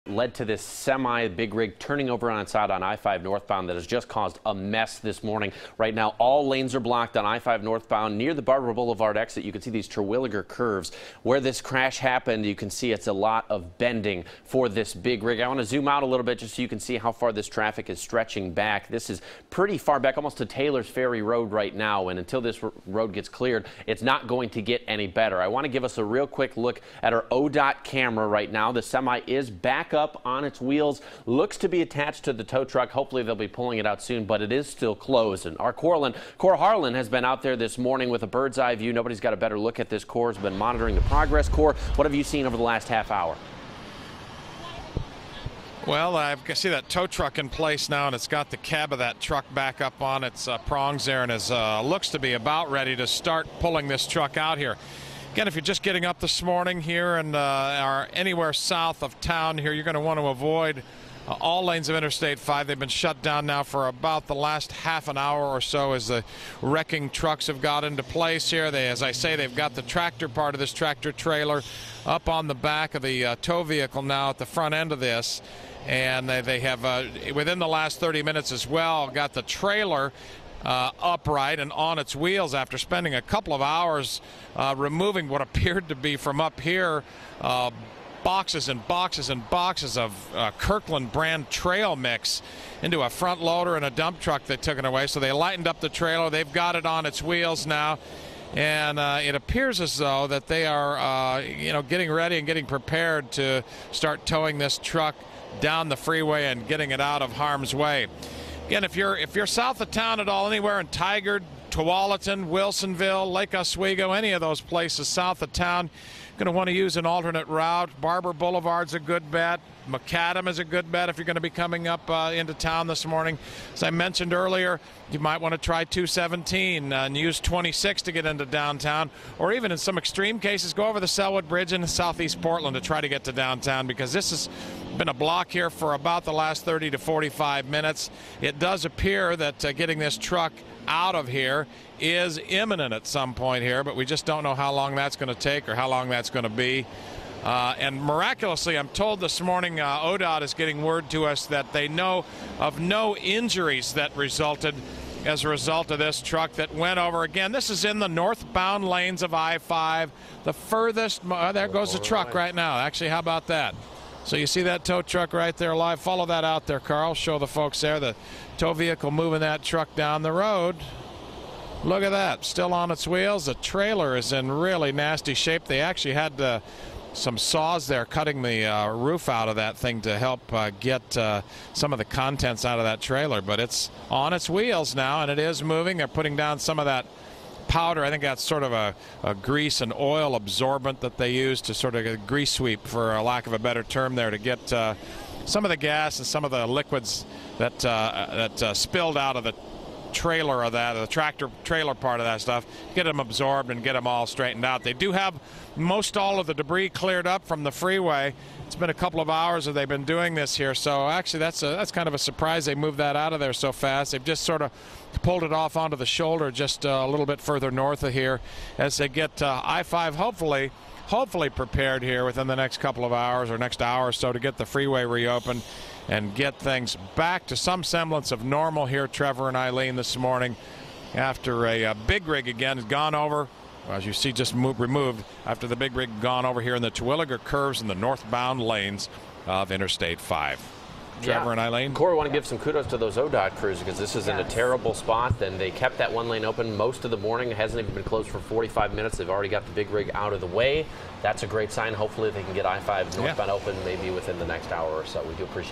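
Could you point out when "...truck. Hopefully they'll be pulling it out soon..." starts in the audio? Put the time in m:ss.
0:32.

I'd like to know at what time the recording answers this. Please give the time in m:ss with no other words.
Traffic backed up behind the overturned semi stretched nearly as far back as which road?
0:20.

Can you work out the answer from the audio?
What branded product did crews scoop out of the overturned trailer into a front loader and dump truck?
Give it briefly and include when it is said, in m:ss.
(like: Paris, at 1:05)
Kirkland brand trail mix, at 1:30.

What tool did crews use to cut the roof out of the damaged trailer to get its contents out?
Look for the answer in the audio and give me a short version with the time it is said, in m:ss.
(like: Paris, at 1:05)
Saws, at 2:57.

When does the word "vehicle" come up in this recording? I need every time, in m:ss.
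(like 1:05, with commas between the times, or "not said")
1:13, 2:48.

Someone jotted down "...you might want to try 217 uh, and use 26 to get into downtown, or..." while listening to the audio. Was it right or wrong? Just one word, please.
right.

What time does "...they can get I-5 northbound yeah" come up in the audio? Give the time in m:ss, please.
4:12.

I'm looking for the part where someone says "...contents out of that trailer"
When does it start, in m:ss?
3:02.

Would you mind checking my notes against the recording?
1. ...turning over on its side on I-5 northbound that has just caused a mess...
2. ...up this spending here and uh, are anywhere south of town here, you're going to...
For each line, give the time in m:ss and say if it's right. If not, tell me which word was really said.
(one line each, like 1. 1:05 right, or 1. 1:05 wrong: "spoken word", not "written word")
1. 0:01 right
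2. 0:56 wrong: "morning", not "spending".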